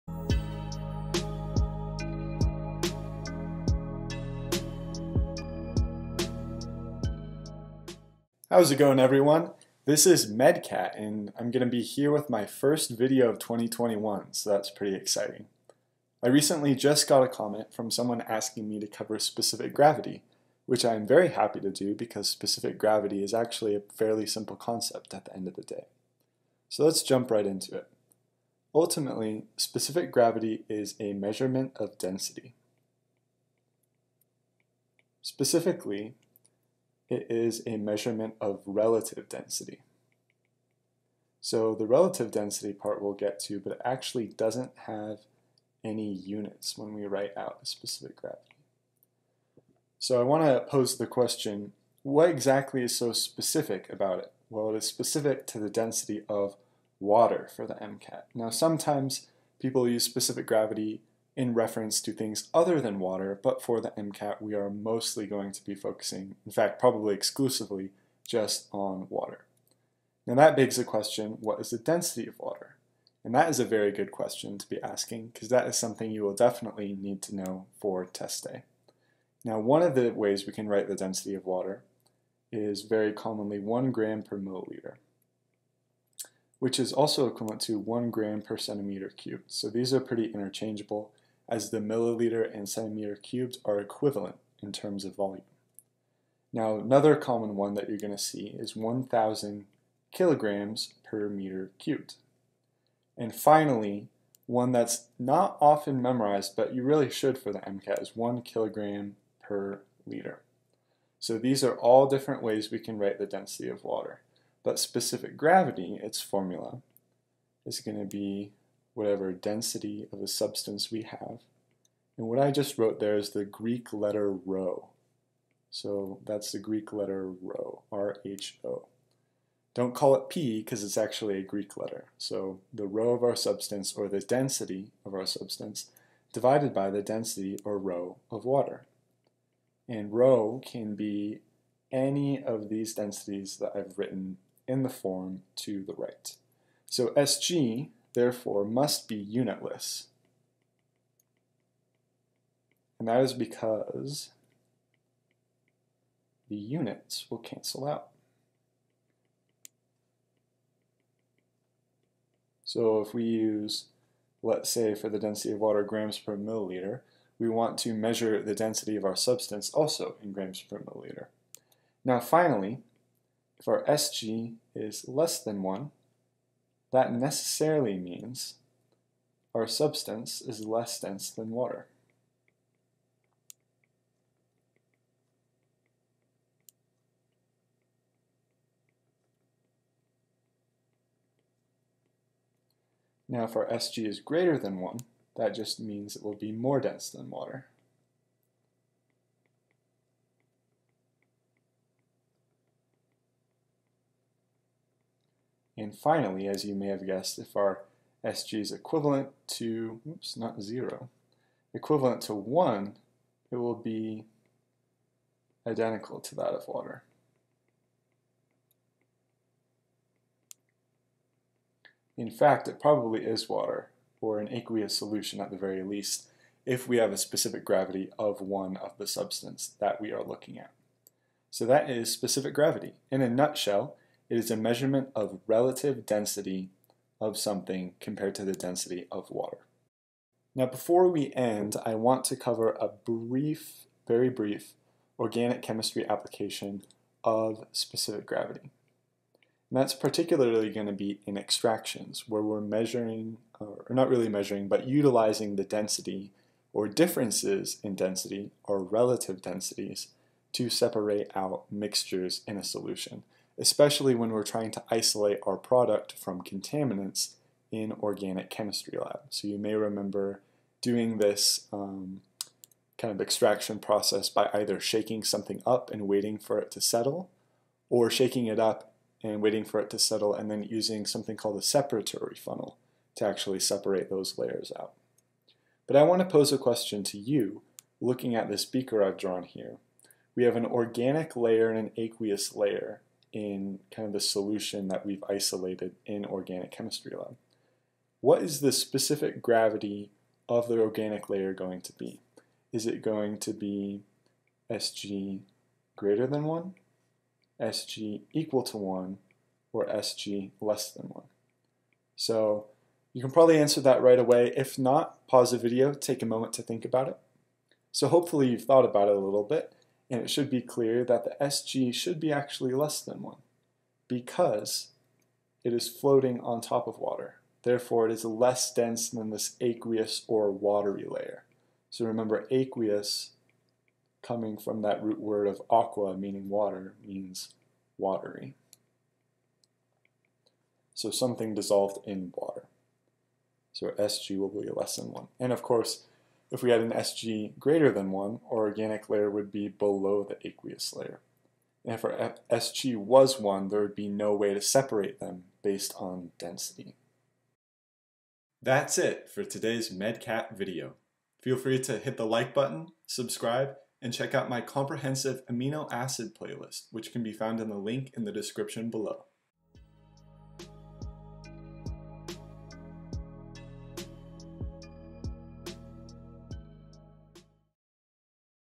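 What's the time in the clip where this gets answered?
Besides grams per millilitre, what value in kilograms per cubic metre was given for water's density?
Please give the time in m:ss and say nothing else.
1:38.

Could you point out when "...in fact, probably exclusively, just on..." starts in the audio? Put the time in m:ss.
1:06.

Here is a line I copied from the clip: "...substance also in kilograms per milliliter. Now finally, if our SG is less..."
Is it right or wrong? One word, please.
wrong.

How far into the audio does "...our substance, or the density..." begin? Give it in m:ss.
2:13.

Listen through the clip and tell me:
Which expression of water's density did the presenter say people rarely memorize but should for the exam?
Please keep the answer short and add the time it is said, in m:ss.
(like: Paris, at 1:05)
1 kilogram per liter, at 1:48.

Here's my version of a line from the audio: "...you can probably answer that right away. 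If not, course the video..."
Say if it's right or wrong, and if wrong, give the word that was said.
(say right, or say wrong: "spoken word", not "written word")
wrong: "pause", not "course".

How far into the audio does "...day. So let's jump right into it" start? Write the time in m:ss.
0:25.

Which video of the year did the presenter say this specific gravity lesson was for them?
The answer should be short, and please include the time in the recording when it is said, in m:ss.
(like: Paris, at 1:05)
first video of 2021, at 0:12.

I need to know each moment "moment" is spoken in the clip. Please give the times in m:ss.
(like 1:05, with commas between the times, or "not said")
5:16.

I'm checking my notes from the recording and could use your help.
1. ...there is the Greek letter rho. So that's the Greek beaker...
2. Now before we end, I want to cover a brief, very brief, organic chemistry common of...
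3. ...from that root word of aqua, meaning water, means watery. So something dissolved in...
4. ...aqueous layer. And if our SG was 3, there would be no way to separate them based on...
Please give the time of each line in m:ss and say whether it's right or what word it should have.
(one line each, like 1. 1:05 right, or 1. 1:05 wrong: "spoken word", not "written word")
1. 2:02 wrong: "letter", not "beaker"
2. 4:00 wrong: "application", not "common"
3. 5:34 right
4. 5:50 wrong: "1", not "3".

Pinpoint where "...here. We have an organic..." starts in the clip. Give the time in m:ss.
4:49.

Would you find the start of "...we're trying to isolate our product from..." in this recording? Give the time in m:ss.
4:24.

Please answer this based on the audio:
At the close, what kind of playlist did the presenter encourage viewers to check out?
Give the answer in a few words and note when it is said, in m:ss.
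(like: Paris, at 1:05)
comprehensive amino acid playlist, at 6:04.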